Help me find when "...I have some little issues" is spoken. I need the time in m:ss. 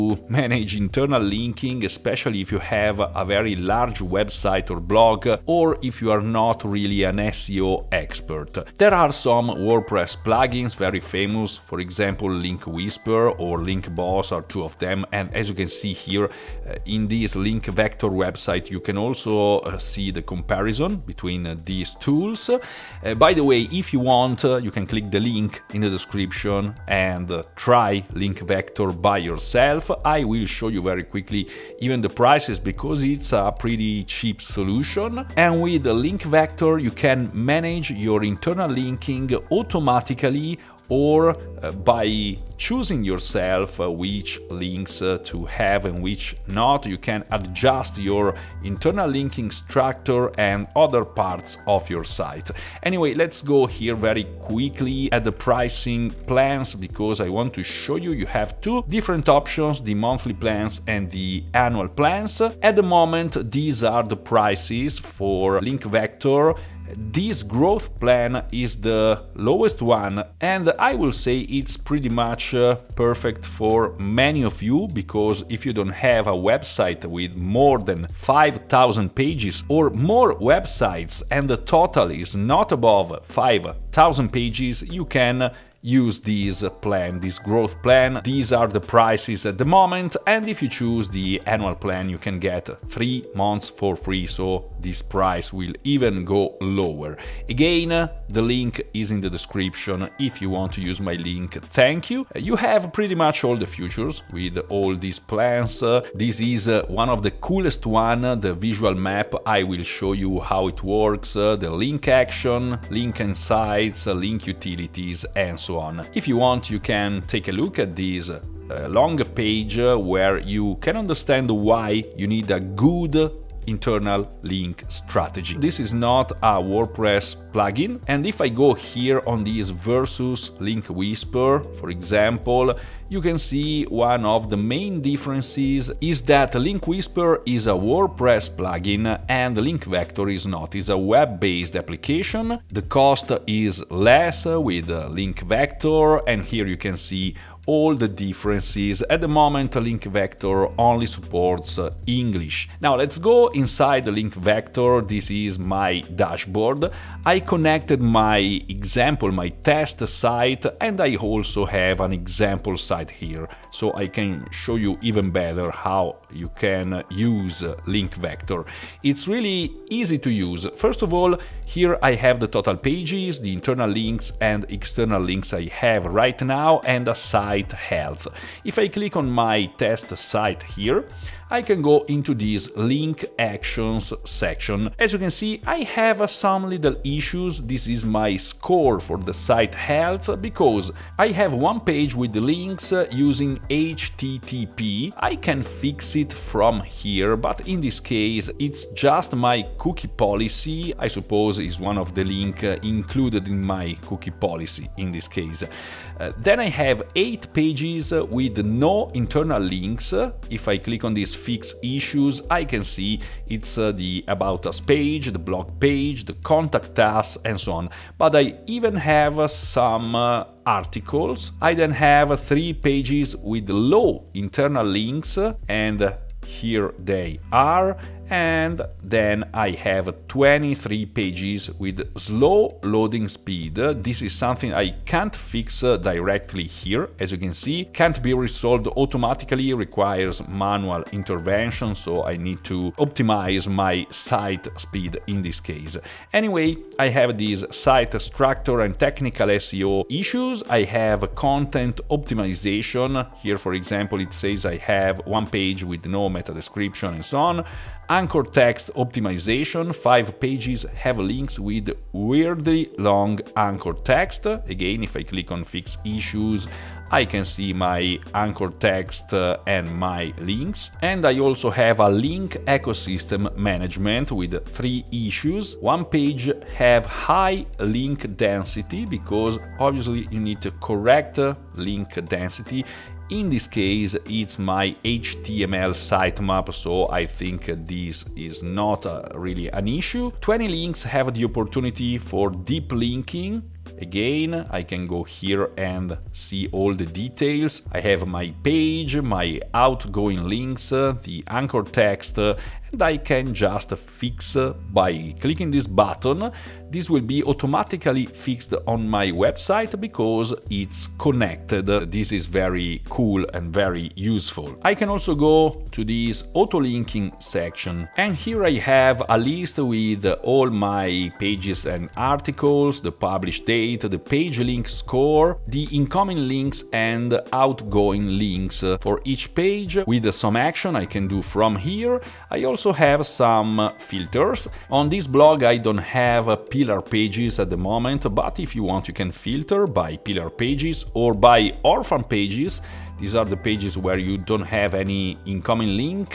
3:05.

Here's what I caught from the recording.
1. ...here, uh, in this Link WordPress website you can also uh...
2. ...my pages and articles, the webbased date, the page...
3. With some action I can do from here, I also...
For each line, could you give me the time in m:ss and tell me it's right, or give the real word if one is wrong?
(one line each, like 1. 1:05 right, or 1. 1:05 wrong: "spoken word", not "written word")
1. 0:15 wrong: "Vector", not "WordPress"
2. 5:20 wrong: "published", not "webbased"
3. 5:30 right.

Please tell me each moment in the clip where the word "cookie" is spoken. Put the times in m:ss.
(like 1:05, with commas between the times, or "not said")
3:19, 3:24.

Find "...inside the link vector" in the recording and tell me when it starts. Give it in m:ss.
2:33.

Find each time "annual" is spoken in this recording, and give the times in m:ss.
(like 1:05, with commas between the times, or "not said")
1:01, 1:31.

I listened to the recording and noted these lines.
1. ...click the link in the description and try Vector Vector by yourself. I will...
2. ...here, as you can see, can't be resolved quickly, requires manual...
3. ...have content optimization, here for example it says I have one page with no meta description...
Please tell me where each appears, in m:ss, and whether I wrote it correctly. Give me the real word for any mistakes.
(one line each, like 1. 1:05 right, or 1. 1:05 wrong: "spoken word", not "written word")
1. 0:24 wrong: "Link", not "Vector"
2. 3:56 wrong: "automatically", not "quickly"
3. 4:10 right.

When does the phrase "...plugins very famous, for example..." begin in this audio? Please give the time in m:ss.
0:10.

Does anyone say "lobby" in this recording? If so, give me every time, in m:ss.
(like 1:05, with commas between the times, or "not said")
not said.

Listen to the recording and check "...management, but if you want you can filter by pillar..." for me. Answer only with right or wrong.
wrong.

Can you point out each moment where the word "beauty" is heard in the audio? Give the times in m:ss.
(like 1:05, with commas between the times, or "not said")
not said.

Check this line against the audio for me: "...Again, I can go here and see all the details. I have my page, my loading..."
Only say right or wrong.
wrong.